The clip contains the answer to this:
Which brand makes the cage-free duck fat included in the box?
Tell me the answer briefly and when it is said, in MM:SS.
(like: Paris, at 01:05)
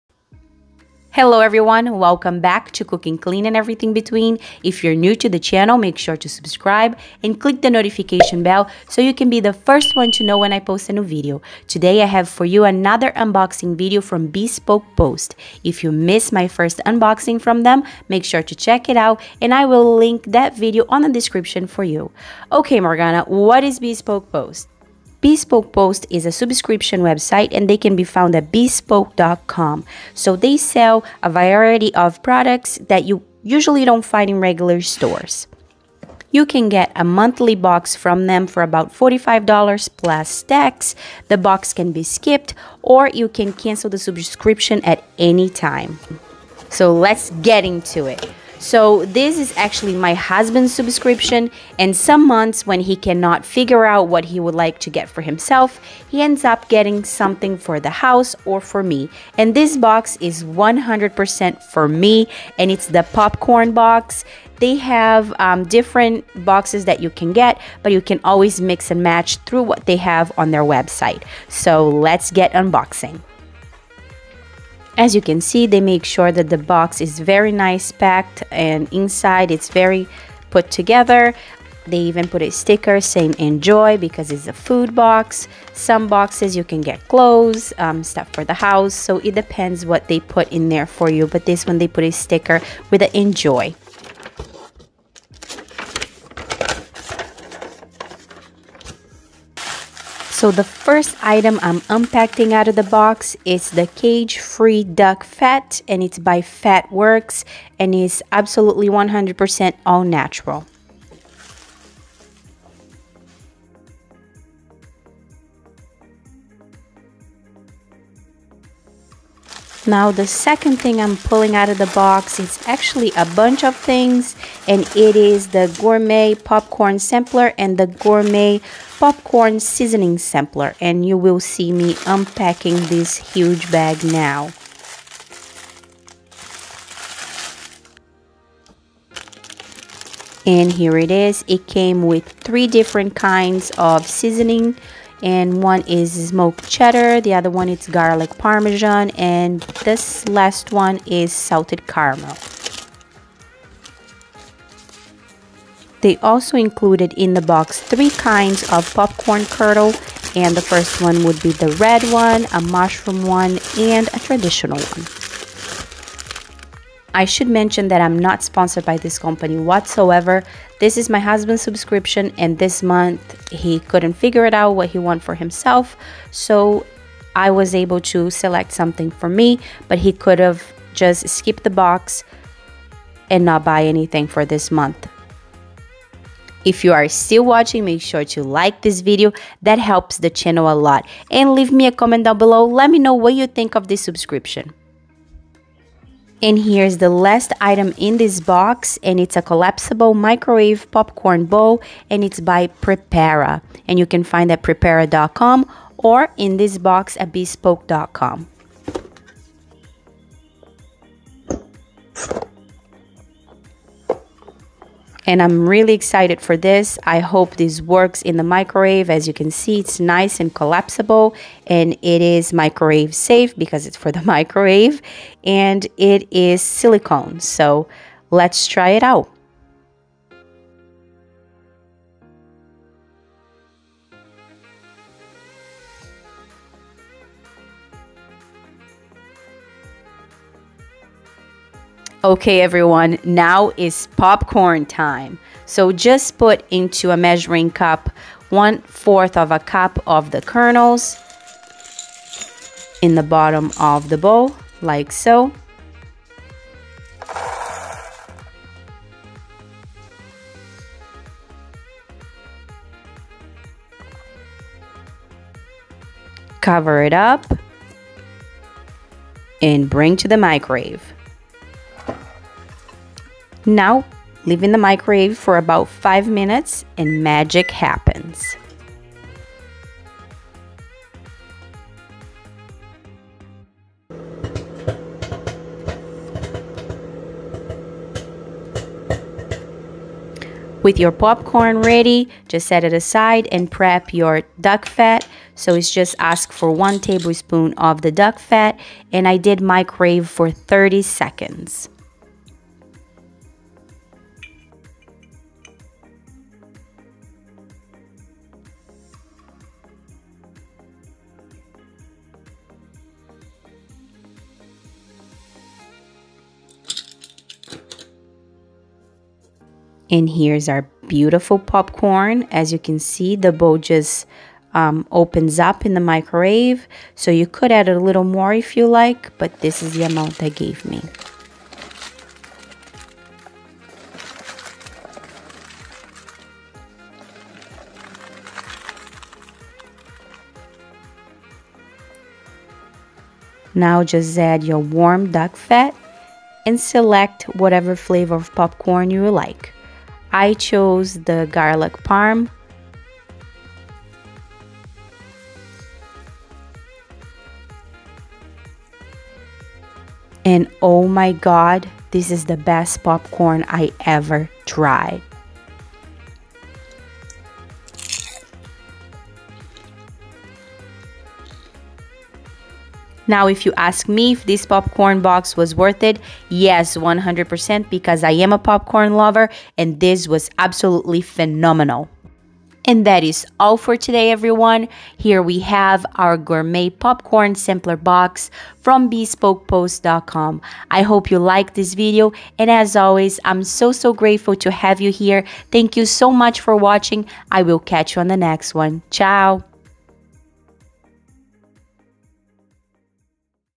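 Fatworks, at 01:46.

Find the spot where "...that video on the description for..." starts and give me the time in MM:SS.
00:20.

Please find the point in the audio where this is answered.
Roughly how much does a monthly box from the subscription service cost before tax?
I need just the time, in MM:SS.
00:38.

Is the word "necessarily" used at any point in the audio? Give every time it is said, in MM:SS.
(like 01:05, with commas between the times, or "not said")
not said.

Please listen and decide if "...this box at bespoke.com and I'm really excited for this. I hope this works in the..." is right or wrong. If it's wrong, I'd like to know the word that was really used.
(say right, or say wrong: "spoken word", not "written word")
right.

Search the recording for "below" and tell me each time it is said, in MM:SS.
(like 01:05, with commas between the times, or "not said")
03:12.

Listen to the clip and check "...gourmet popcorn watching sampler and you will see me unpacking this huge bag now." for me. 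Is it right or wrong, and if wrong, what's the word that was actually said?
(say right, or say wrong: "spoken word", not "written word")
wrong: "seasoning", not "watching".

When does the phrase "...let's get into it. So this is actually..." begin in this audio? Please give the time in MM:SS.
00:46.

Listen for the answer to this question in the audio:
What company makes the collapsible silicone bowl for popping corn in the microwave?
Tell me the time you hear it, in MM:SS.
03:22.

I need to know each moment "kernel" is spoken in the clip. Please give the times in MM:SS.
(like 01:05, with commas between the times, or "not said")
02:39, 04:10.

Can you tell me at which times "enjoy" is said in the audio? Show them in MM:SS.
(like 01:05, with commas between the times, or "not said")
01:23, 01:33.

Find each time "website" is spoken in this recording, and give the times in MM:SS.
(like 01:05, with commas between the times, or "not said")
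00:27, 01:10.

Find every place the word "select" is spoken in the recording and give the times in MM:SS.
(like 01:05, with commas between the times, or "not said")
02:58, 05:46.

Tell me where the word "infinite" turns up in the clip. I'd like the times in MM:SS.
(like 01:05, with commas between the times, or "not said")
not said.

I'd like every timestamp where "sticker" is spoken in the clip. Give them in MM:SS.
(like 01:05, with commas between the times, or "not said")
01:22, 01:32.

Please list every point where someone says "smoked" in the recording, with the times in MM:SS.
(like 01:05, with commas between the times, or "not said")
02:26.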